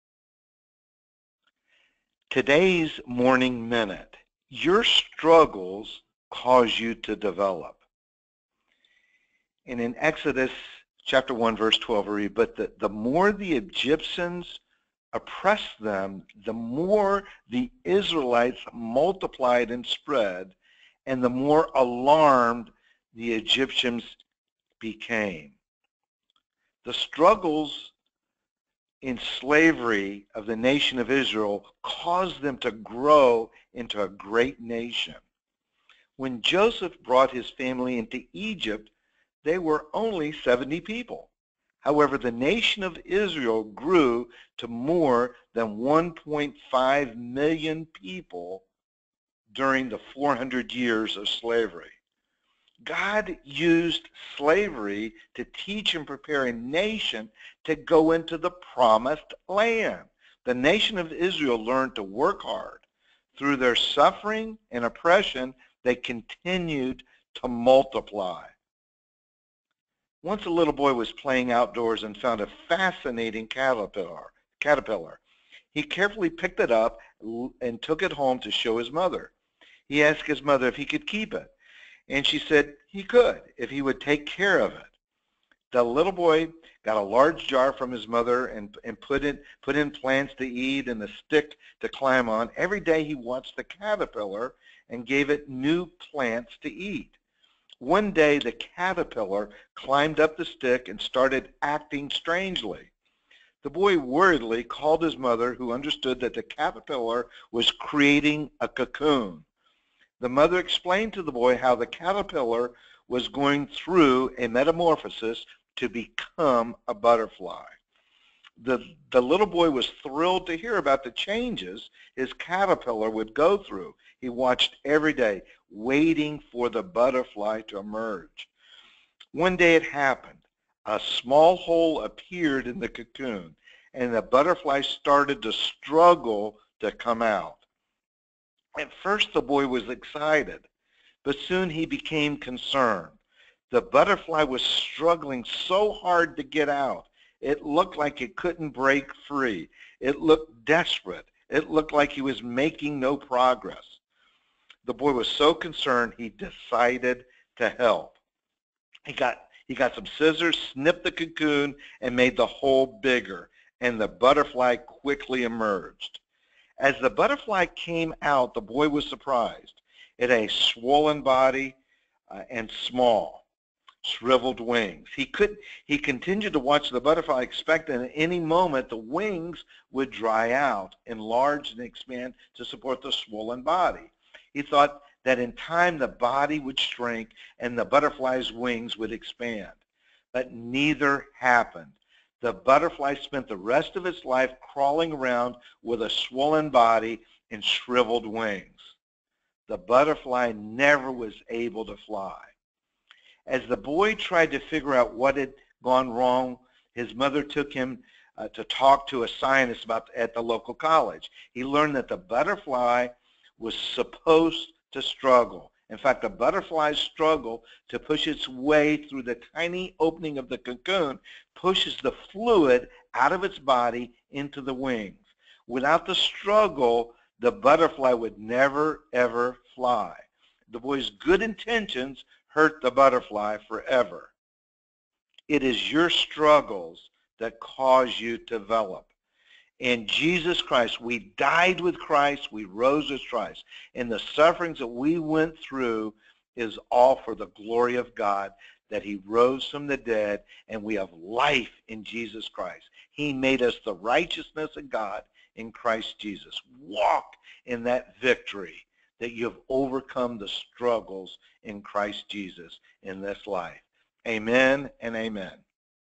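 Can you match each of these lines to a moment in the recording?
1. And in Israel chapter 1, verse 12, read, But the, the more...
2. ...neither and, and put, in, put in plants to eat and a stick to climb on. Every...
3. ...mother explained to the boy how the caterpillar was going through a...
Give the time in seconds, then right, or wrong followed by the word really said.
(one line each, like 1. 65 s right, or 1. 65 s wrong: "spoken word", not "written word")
1. 9 s wrong: "Exodus", not "Israel"
2. 88 s wrong: "mother", not "neither"
3. 110 s right.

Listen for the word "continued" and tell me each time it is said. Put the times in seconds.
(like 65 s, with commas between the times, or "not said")
65 s, 175 s.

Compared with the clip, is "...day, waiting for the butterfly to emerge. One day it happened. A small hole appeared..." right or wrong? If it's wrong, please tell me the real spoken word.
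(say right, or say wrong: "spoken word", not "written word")
right.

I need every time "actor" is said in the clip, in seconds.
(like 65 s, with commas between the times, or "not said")
not said.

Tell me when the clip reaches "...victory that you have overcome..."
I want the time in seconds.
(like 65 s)
258 s.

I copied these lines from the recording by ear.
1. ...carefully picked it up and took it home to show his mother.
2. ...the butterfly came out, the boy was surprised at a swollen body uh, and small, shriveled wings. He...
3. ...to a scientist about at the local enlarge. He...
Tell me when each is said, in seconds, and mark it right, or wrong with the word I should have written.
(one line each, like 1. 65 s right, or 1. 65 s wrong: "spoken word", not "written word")
1. 75 s right
2. 166 s right
3. 209 s wrong: "college", not "enlarge".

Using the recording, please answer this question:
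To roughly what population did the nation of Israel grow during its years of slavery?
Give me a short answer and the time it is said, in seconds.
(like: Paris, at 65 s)
1.5 million, at 45 s.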